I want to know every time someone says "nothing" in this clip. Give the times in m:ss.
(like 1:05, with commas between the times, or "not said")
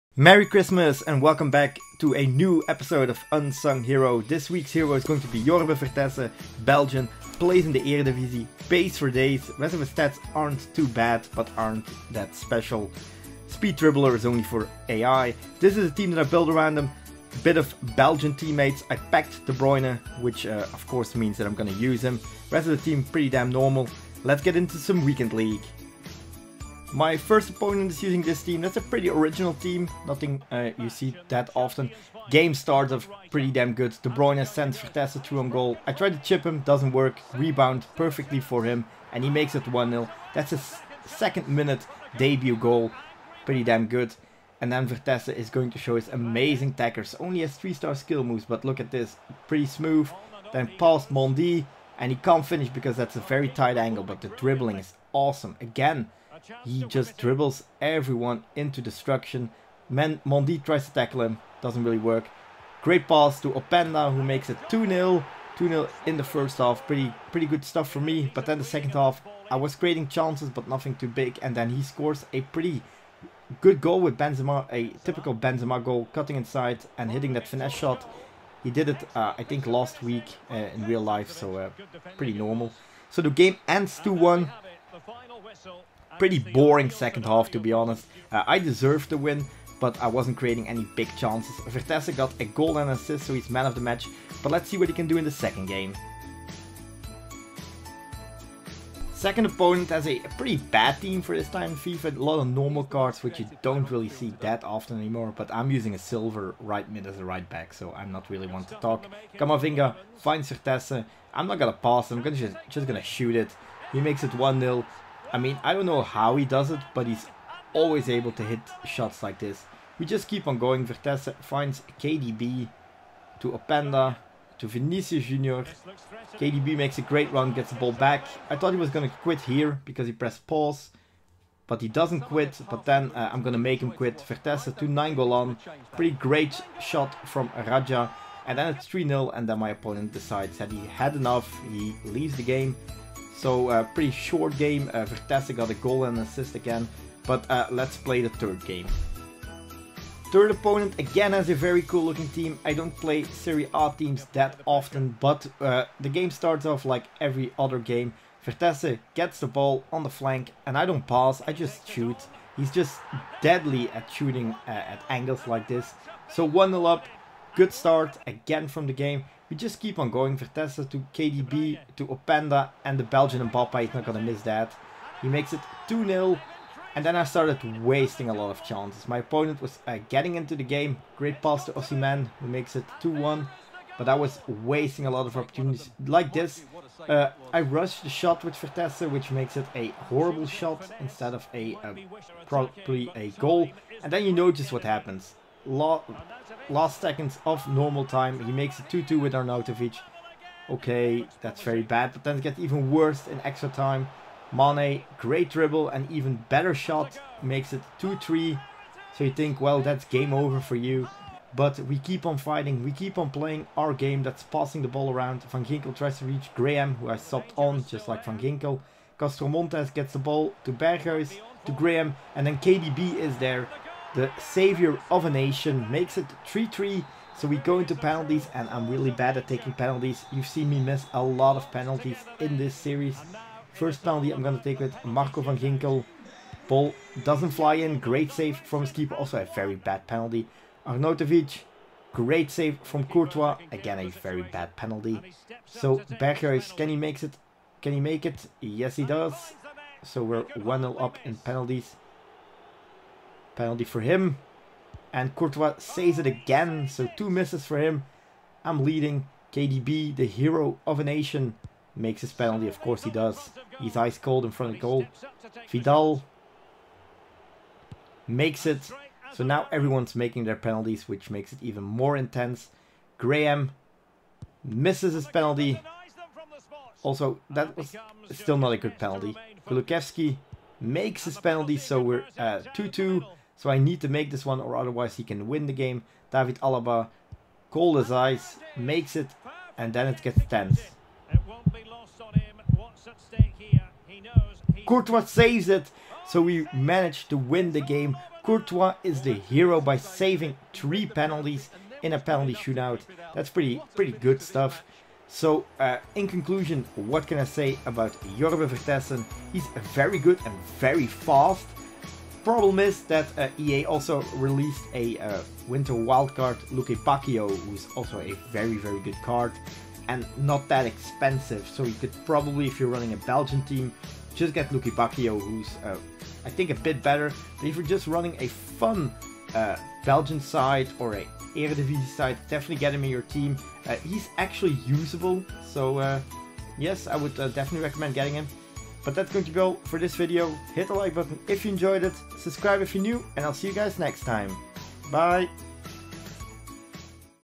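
0:30, 1:10.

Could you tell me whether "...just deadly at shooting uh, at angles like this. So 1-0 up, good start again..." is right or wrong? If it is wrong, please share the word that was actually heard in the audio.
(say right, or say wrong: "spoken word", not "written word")
right.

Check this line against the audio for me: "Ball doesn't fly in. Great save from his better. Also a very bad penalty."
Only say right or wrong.
wrong.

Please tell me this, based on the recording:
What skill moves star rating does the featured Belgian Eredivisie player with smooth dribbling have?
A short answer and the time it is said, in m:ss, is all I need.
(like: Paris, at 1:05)
3, at 0:47.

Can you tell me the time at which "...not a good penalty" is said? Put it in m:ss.
4:38.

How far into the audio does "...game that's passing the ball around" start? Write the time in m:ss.
3:33.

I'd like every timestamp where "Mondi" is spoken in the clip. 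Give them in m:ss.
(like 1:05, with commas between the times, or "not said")
0:51, 1:00.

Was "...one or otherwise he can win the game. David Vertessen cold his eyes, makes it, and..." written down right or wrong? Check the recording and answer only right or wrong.
wrong.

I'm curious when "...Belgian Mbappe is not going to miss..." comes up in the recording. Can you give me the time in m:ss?
2:53.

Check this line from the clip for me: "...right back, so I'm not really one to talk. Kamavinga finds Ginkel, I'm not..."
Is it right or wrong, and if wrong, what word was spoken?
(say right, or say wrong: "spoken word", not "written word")
wrong: "Vertessen", not "Ginkel".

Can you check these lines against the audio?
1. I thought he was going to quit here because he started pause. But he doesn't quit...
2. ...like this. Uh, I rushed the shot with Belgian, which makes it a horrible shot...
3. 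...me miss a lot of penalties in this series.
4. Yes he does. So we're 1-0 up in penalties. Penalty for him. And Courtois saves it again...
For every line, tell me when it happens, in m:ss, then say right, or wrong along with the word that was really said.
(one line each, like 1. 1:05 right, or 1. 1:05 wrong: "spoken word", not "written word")
1. 2:08 wrong: "pressed", not "started"
2. 3:06 wrong: "Vertessen", not "Belgian"
3. 3:50 right
4. 4:08 right.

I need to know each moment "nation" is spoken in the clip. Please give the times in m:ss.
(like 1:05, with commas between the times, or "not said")
3:45, 4:21.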